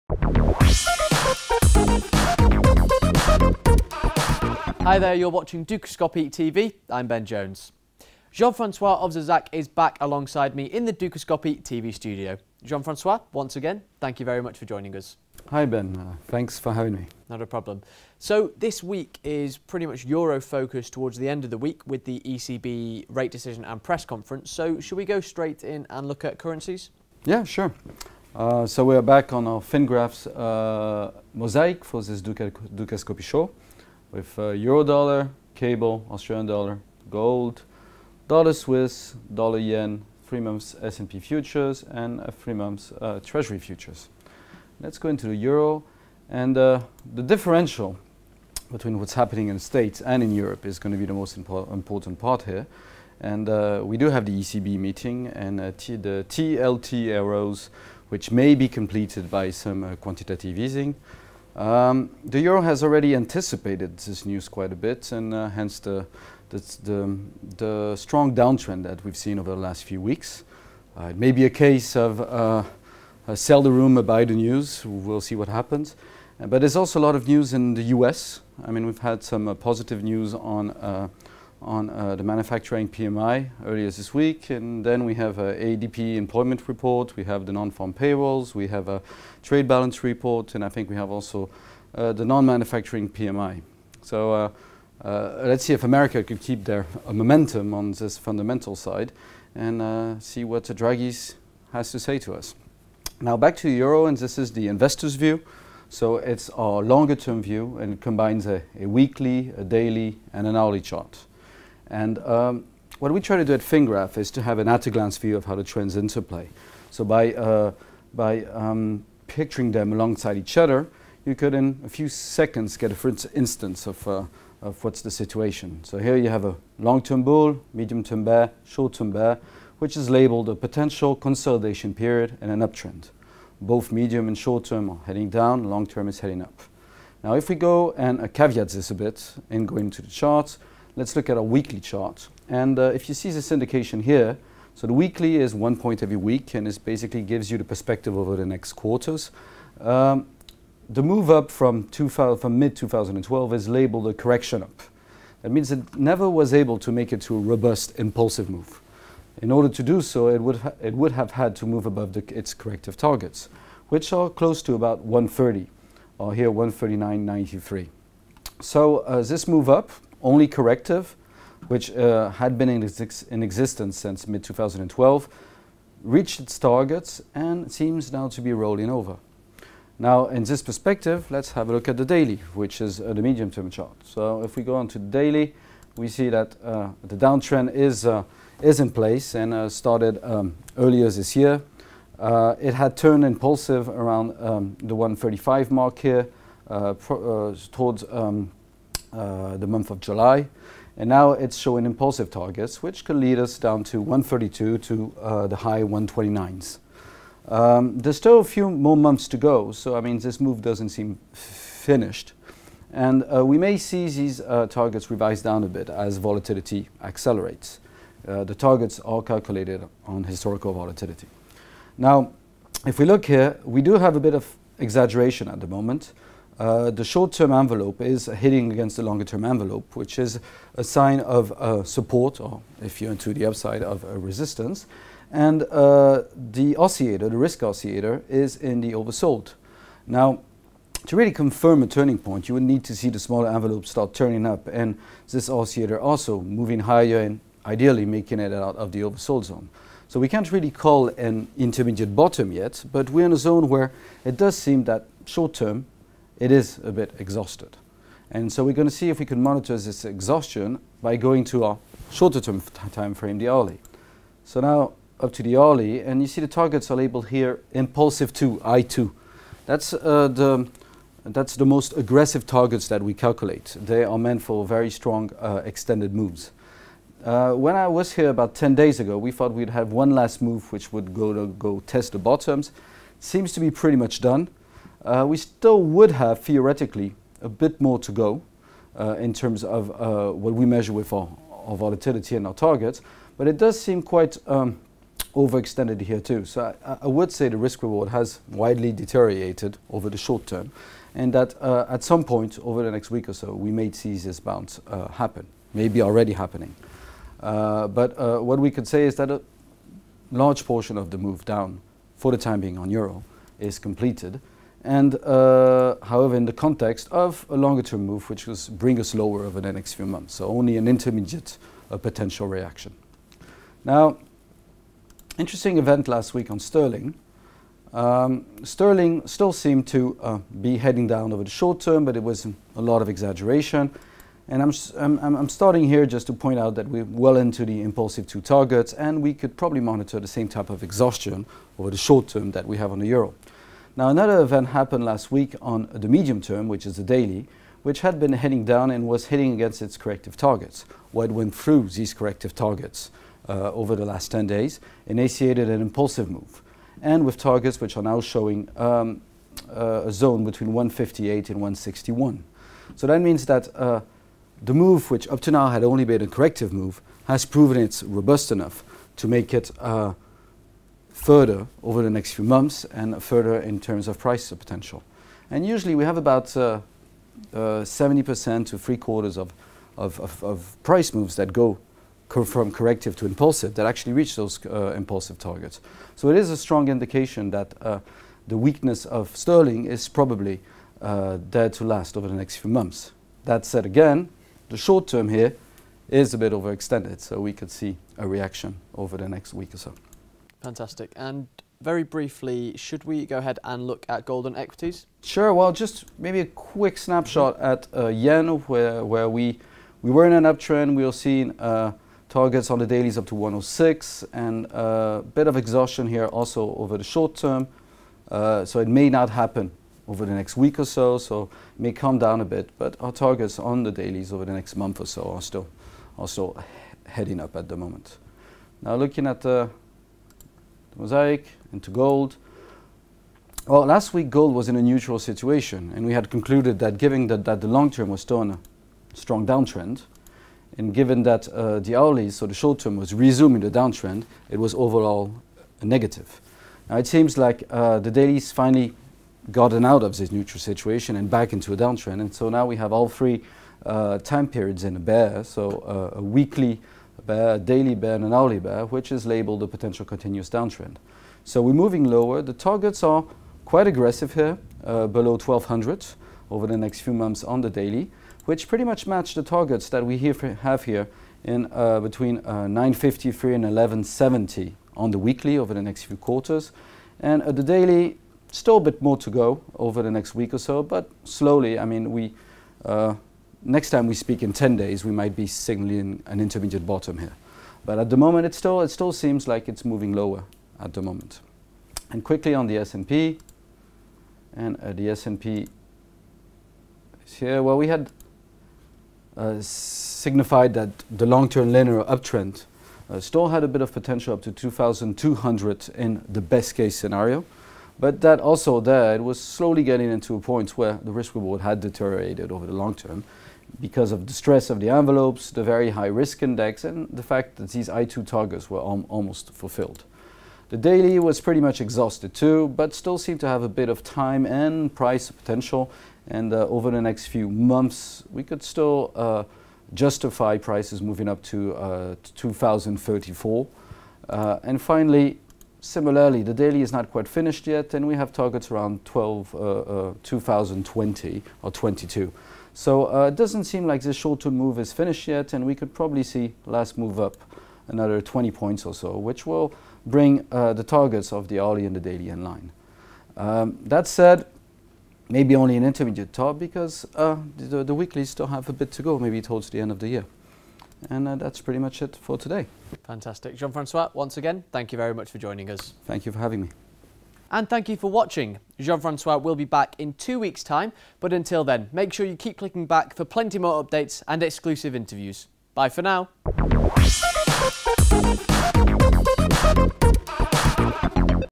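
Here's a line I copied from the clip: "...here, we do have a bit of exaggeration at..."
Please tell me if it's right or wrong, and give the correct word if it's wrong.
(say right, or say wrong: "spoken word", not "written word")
right.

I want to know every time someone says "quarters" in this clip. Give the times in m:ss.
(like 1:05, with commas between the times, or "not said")
2:28, 6:18, 7:56.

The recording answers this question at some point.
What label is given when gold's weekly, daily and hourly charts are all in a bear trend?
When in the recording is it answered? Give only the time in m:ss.
7:39.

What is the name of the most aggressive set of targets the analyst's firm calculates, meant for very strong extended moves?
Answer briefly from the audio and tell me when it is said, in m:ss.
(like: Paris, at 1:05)
Impulsive 2, at 4:27.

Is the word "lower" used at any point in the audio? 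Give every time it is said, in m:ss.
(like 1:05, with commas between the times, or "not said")
5:19, 7:42, 8:10.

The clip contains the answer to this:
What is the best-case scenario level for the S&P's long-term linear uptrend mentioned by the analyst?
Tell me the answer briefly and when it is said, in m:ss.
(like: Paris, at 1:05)
2,200, at 8:24.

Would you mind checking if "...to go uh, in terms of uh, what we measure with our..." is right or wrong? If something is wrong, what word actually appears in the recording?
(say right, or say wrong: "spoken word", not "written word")
right.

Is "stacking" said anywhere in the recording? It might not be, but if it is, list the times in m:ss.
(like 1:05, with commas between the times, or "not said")
not said.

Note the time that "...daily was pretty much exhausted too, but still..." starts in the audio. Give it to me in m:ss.
8:40.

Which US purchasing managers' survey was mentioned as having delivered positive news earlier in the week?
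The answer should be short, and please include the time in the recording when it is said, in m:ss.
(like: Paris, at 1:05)
Manufacturing PMI, at 1:22.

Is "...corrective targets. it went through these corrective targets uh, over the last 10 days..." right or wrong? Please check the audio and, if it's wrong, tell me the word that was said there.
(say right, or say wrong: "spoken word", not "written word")
right.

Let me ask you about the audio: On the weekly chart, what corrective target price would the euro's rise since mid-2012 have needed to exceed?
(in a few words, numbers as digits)
139.93.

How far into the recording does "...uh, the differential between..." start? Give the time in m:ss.
0:46.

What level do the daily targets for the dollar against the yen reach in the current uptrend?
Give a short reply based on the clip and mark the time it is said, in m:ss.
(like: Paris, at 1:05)
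106, at 6:53.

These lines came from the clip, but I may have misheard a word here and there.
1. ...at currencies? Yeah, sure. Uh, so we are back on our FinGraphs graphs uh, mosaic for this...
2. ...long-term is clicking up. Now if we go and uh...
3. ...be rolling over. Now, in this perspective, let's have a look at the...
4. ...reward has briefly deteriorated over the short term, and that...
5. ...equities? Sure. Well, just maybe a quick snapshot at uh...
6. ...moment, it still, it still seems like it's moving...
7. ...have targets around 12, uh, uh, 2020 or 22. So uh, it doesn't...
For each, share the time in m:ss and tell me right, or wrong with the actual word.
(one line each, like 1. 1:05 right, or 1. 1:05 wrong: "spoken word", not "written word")
1. 0:26 right
2. 2:15 wrong: "heading", not "clicking"
3. 2:58 right
4. 4:57 wrong: "widely", not "briefly"
5. 6:44 right
6. 8:08 right
7. 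8:58 right.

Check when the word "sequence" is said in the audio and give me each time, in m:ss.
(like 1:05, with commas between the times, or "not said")
not said.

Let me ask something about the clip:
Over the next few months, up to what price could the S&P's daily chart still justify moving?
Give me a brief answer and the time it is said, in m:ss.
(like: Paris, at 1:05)
2034, at 8:52.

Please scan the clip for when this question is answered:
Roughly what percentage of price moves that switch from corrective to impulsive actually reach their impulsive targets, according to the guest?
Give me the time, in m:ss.
6:16.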